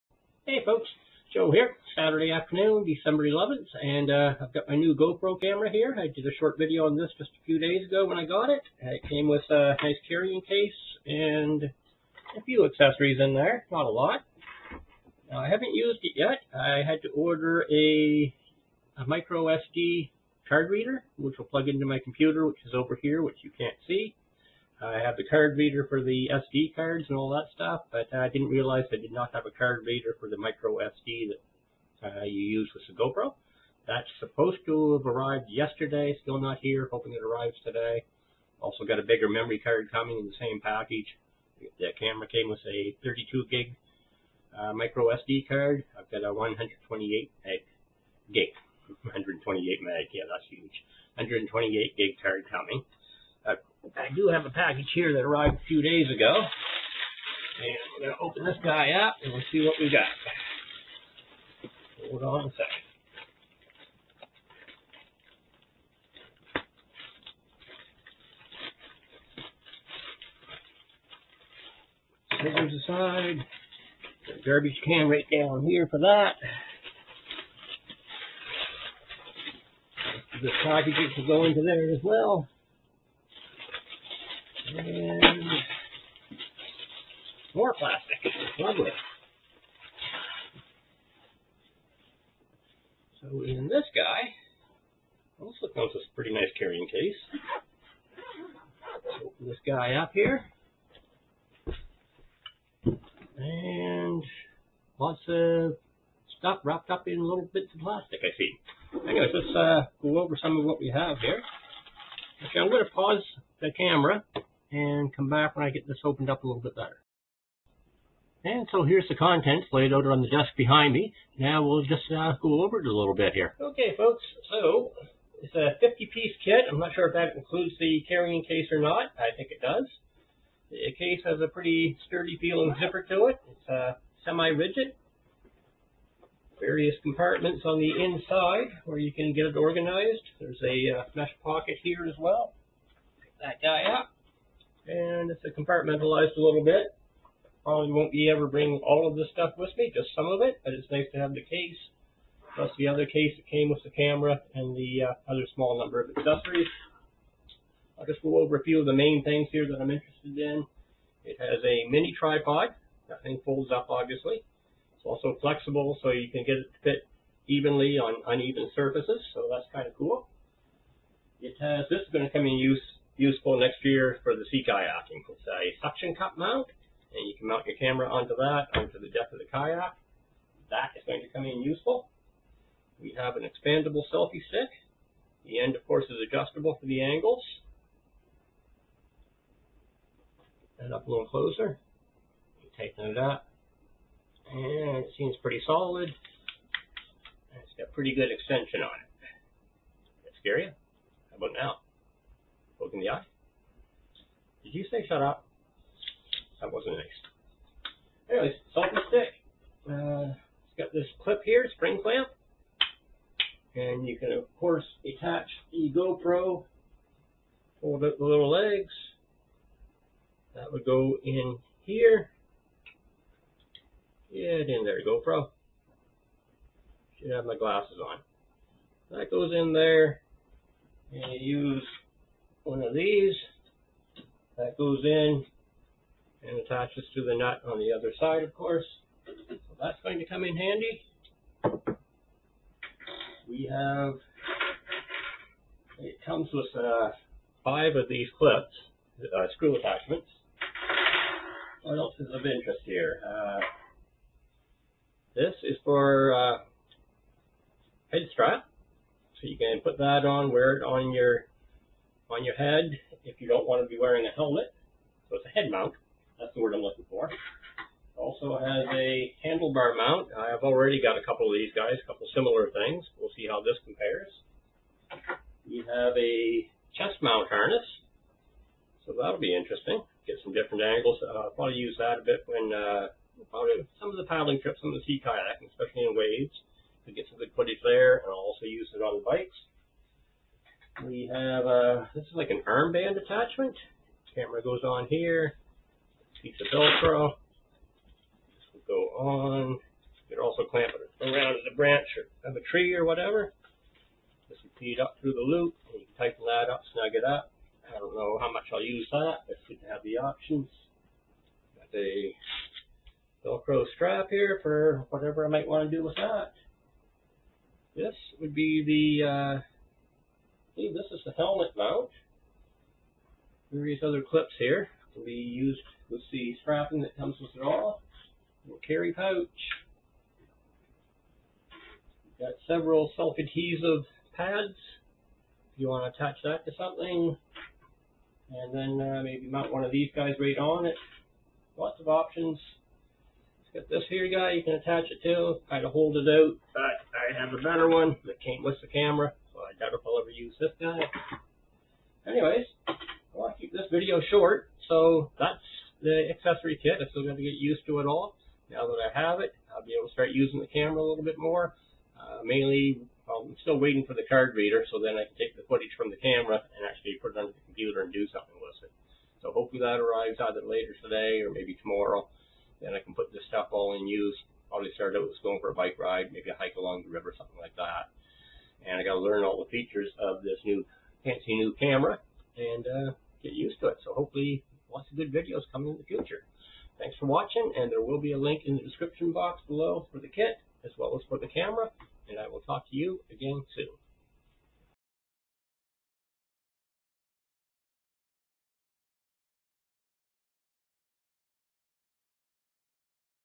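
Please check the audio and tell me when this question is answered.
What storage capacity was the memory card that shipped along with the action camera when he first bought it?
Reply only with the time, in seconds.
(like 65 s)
43 s.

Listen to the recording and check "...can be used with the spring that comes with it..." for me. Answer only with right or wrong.
wrong.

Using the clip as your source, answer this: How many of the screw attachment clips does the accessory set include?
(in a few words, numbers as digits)
five.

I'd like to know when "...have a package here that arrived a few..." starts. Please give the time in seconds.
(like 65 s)
54 s.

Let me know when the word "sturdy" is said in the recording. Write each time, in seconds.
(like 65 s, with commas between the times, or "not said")
132 s.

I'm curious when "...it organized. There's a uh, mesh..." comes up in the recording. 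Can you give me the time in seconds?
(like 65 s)
139 s.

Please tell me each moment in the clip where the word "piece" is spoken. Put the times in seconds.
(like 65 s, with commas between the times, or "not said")
125 s, 296 s.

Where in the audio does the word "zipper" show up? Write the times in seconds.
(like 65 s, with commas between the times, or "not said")
132 s.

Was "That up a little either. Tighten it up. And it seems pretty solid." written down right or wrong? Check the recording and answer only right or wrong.
wrong.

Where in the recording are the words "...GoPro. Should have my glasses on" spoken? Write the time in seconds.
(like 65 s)
225 s.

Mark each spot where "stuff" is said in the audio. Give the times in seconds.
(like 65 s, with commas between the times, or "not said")
27 s, 106 s, 149 s, 373 s.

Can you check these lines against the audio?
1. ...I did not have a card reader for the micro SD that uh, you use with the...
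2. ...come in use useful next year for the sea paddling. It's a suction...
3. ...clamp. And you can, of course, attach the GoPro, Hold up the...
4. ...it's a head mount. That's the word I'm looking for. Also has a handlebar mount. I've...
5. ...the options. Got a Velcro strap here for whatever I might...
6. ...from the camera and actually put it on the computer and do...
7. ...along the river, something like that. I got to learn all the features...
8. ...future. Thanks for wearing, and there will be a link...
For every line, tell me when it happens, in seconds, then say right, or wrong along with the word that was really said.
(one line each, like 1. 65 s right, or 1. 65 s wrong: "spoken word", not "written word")
1. 28 s right
2. 172 s wrong: "kayaking", not "paddling"
3. 212 s right
4. 265 s right
5. 310 s right
6. 365 s right
7. 376 s right
8. 386 s wrong: "watching", not "wearing".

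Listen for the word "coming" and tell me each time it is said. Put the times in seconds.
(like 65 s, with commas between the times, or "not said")
39 s, 52 s, 385 s.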